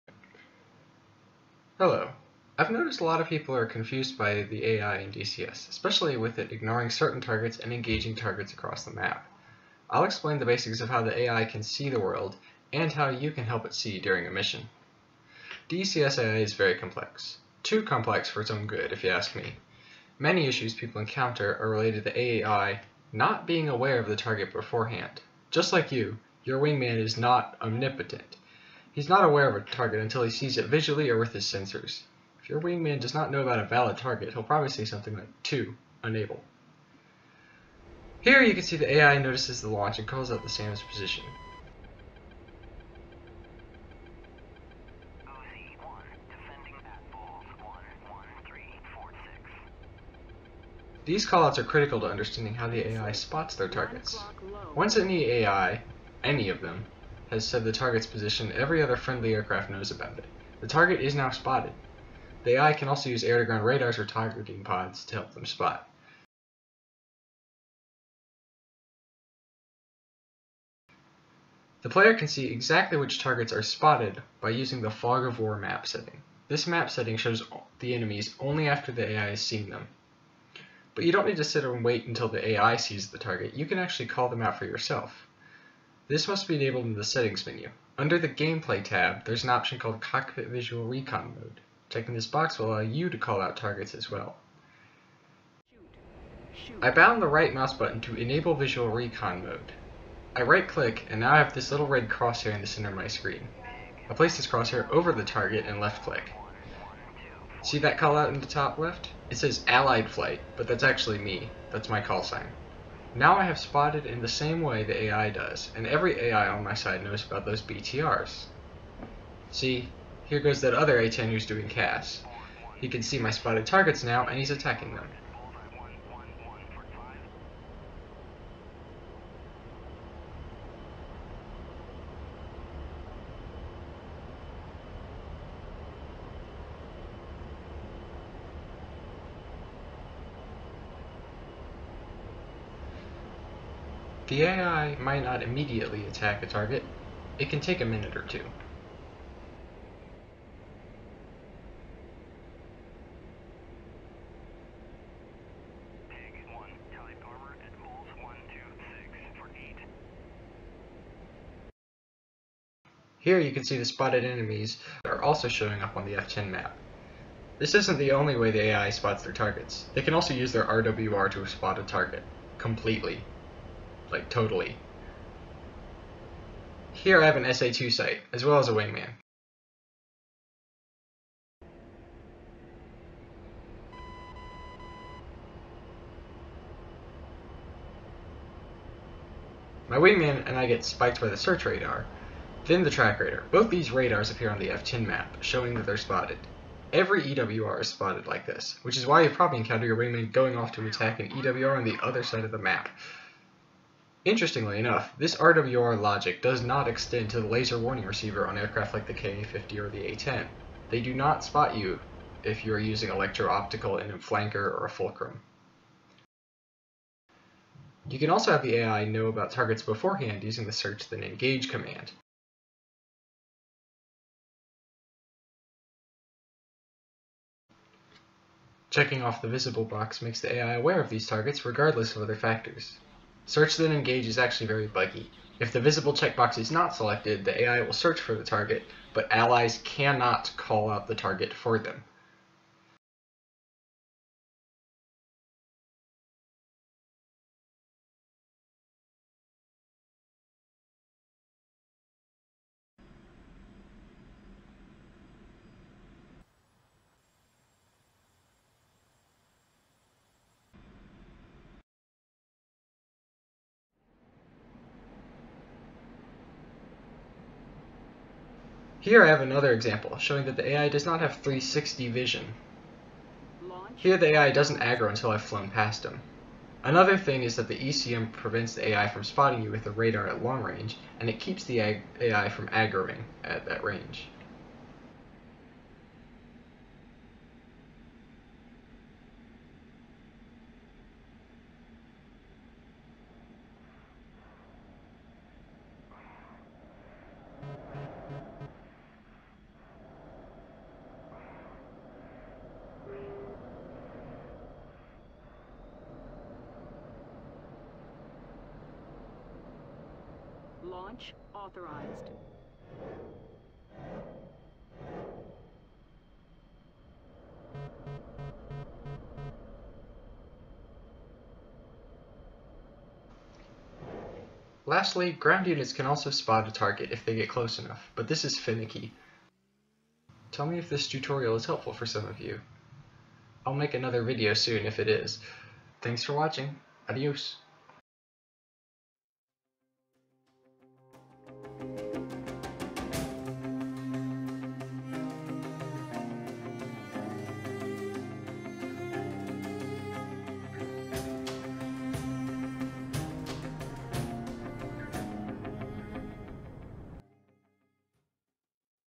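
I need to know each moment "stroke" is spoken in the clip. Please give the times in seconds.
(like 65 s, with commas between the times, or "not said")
not said.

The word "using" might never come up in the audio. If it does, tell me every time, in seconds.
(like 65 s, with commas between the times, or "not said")
74 s, 212 s, 220 s.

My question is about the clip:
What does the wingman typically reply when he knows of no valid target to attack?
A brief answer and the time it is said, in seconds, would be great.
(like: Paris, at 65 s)
2, unable, at 35 s.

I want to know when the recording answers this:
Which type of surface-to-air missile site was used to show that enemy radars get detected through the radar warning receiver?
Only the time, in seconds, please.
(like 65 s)
177 s.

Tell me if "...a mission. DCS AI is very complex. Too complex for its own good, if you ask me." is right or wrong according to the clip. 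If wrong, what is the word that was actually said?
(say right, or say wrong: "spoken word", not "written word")
right.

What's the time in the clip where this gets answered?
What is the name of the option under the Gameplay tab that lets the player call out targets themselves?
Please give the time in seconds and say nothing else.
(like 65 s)
90 s.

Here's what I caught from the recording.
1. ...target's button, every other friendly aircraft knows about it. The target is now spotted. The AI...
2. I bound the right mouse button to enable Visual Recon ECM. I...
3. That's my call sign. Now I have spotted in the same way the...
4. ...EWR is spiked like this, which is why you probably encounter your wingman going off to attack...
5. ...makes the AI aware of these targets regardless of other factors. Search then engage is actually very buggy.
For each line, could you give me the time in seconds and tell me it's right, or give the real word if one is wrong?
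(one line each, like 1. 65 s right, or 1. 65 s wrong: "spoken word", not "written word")
1. 57 s wrong: "position", not "button"
2. 96 s wrong: "Mode", not "ECM"
3. 111 s right
4. 197 s wrong: "spotted", not "spiked"
5. 230 s right.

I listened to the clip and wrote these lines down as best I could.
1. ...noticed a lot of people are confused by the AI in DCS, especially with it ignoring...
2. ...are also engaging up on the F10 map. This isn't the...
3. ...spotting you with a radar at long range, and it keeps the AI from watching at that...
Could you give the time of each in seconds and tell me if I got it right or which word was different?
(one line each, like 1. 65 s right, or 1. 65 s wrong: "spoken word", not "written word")
1. 2 s right
2. 165 s wrong: "showing", not "engaging"
3. 279 s wrong: "aggroing", not "watching".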